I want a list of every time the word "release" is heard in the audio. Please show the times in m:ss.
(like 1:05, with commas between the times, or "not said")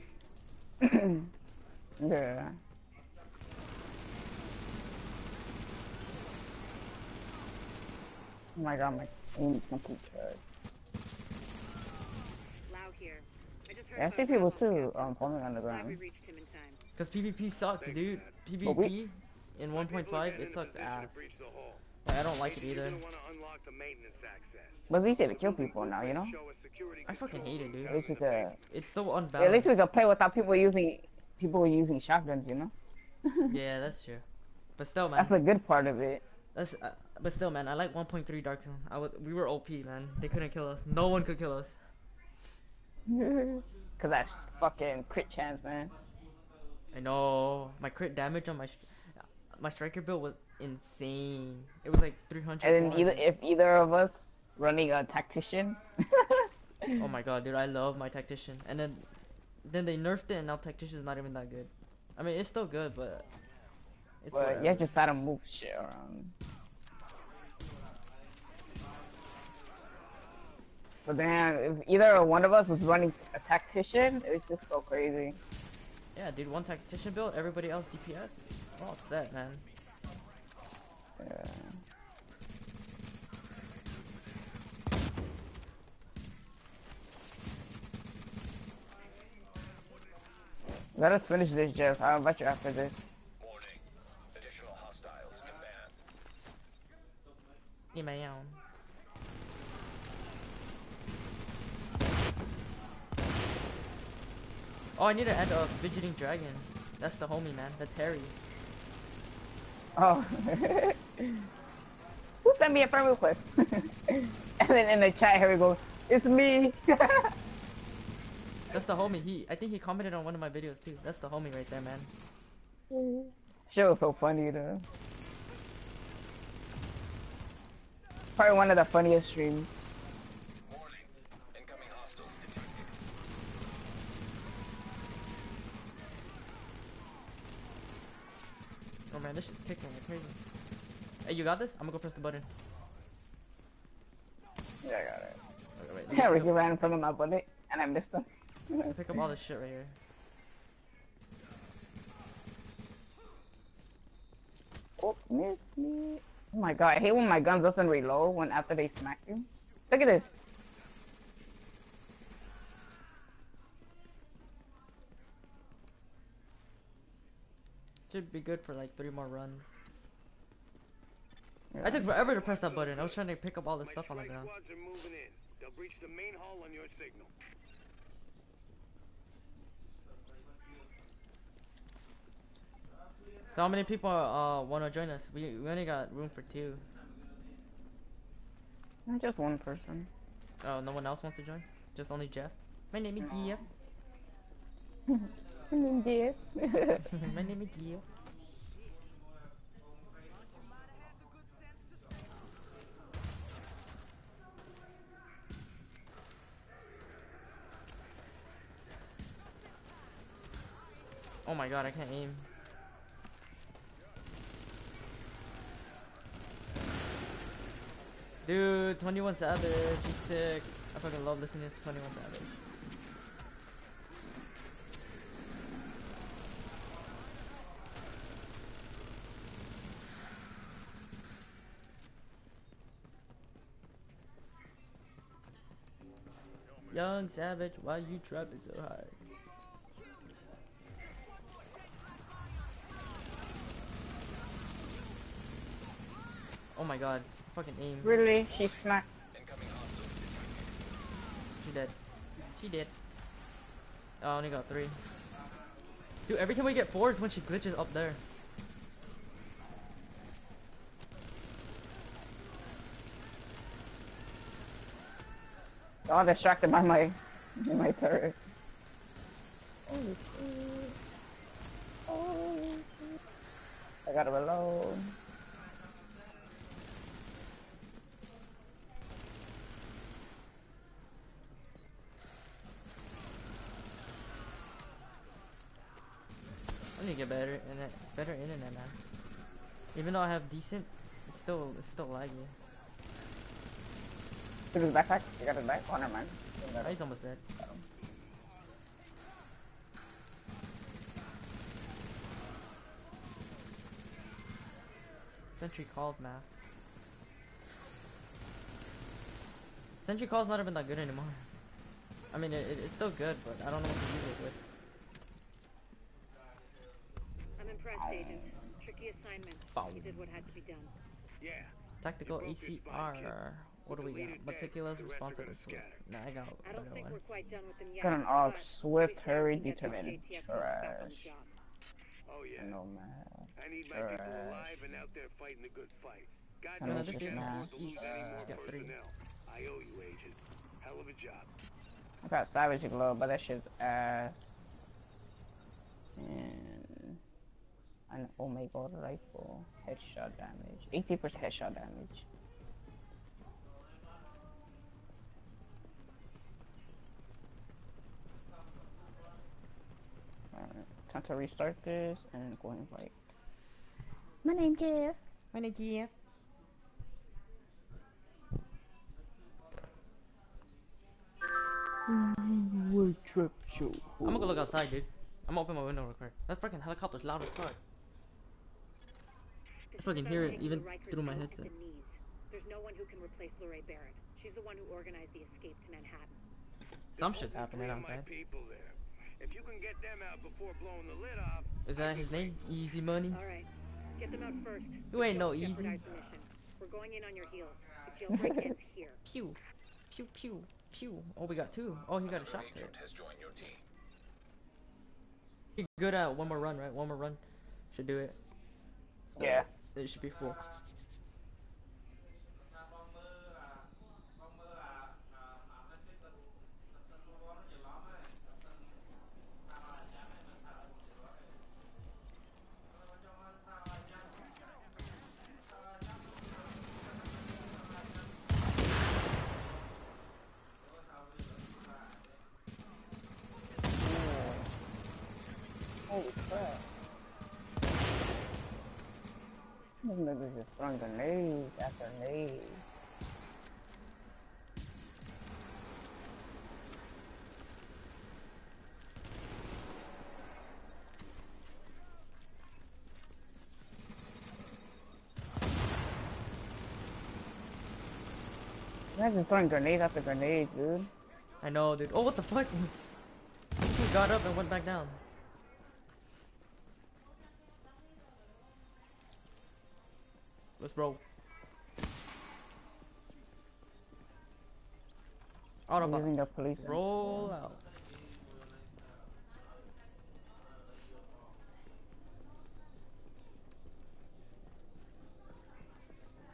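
not said.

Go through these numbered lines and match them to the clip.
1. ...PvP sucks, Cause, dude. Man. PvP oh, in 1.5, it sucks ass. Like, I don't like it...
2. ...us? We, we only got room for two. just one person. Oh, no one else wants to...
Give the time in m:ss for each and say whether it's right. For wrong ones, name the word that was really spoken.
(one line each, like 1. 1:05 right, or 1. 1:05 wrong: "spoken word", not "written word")
1. 0:17 wrong: "Thanks", not "Cause"
2. 3:05 right.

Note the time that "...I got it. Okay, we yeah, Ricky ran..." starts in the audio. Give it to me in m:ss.
2:25.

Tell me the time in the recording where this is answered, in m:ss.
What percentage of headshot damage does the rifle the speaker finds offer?
5:50.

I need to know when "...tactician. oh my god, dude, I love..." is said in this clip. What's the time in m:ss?
0:55.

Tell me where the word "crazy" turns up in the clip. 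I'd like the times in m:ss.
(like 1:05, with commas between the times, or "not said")
1:14, 2:20.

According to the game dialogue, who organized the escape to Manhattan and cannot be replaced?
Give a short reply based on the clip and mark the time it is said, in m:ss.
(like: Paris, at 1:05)
Lorraine Barrett, at 6:23.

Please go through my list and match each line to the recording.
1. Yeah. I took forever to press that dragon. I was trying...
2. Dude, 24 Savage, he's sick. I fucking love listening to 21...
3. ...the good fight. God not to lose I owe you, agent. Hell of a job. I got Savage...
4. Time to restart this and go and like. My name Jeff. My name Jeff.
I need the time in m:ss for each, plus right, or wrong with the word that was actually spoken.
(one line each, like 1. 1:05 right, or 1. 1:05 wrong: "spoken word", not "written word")
1. 2:51 wrong: "button", not "dragon"
2. 3:38 wrong: "21", not "24"
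3. 5:35 right
4. 6:01 right.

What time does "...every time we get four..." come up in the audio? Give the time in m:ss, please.
4:16.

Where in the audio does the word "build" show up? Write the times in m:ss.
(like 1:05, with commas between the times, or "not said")
0:50, 1:17.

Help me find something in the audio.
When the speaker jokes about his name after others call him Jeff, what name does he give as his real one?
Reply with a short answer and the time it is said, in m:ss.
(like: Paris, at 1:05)
Gio, at 3:17.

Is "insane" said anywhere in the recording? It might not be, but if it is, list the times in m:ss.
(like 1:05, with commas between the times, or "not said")
0:50.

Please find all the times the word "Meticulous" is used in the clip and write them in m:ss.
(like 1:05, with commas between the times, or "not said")
5:24.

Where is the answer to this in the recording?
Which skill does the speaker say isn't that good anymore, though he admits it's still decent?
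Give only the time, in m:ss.
5:10.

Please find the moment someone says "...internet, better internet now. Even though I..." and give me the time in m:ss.
4:47.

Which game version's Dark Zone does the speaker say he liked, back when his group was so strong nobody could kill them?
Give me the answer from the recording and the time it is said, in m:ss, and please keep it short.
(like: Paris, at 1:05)
1.3, at 0:37.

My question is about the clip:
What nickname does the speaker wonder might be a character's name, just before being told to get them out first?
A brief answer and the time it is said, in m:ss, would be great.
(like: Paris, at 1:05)
Easy Money, at 6:32.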